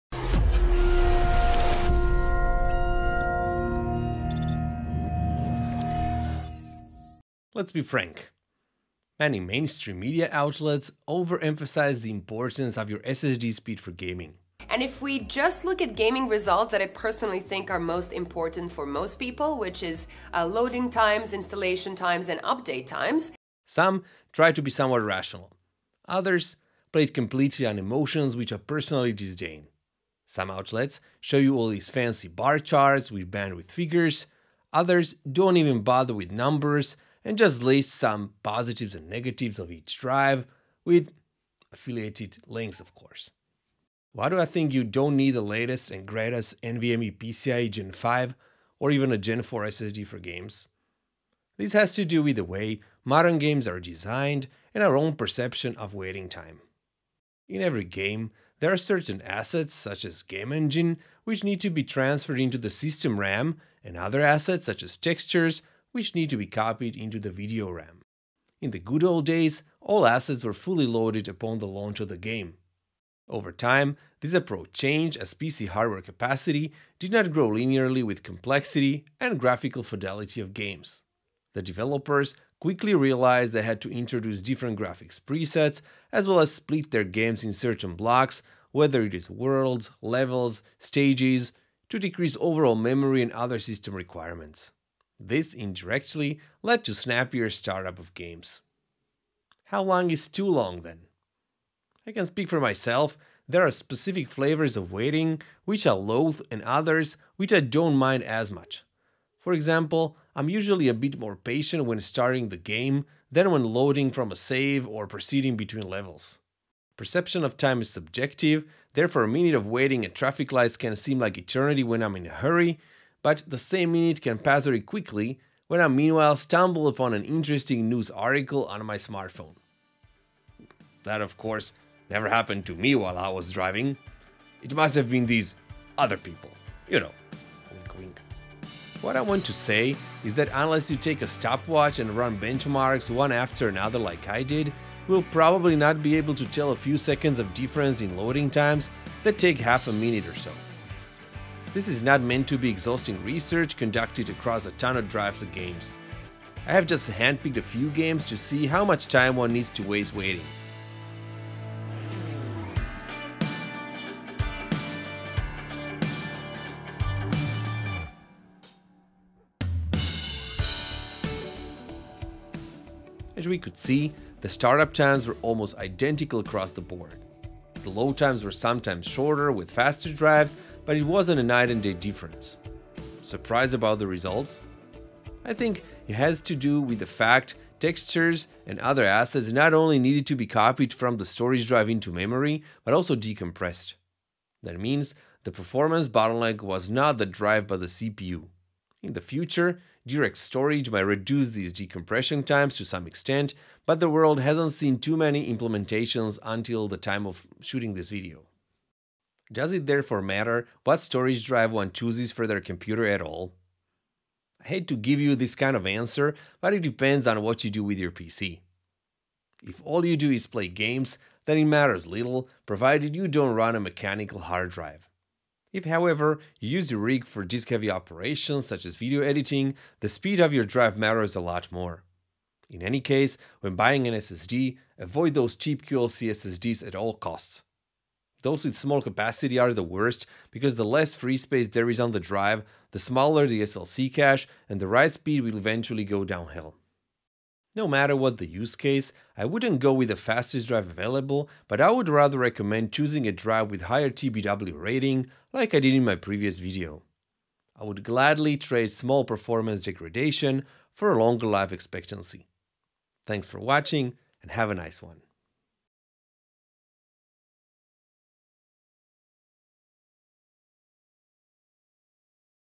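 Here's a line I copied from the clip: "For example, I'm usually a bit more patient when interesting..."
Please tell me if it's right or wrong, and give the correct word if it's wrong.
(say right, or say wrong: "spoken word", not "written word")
wrong: "starting", not "interesting".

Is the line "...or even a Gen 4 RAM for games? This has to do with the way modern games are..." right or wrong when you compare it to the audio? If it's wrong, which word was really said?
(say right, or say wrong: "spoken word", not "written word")
wrong: "SSD", not "RAM".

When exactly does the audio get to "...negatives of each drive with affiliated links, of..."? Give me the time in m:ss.
0:39.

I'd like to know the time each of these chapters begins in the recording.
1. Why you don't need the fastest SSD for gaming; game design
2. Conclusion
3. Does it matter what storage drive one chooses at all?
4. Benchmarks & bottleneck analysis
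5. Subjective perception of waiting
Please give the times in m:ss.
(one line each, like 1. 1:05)
1. 0:44
2. 4:07
3. 3:29
4. 2:18
5. 1:39.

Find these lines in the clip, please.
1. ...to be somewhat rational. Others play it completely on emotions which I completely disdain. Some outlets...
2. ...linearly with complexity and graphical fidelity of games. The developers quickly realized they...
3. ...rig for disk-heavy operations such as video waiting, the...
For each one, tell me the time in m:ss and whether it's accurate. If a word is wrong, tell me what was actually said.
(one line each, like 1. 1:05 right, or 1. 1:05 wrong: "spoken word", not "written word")
1. 0:24 wrong: "personally", not "completely"
2. 1:17 right
3. 3:46 wrong: "editing", not "waiting".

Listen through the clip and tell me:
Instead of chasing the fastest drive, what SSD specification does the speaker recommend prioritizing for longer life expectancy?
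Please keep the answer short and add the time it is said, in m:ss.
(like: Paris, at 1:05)
higher TBW rating, at 4:13.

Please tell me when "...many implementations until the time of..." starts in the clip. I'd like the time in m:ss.
3:25.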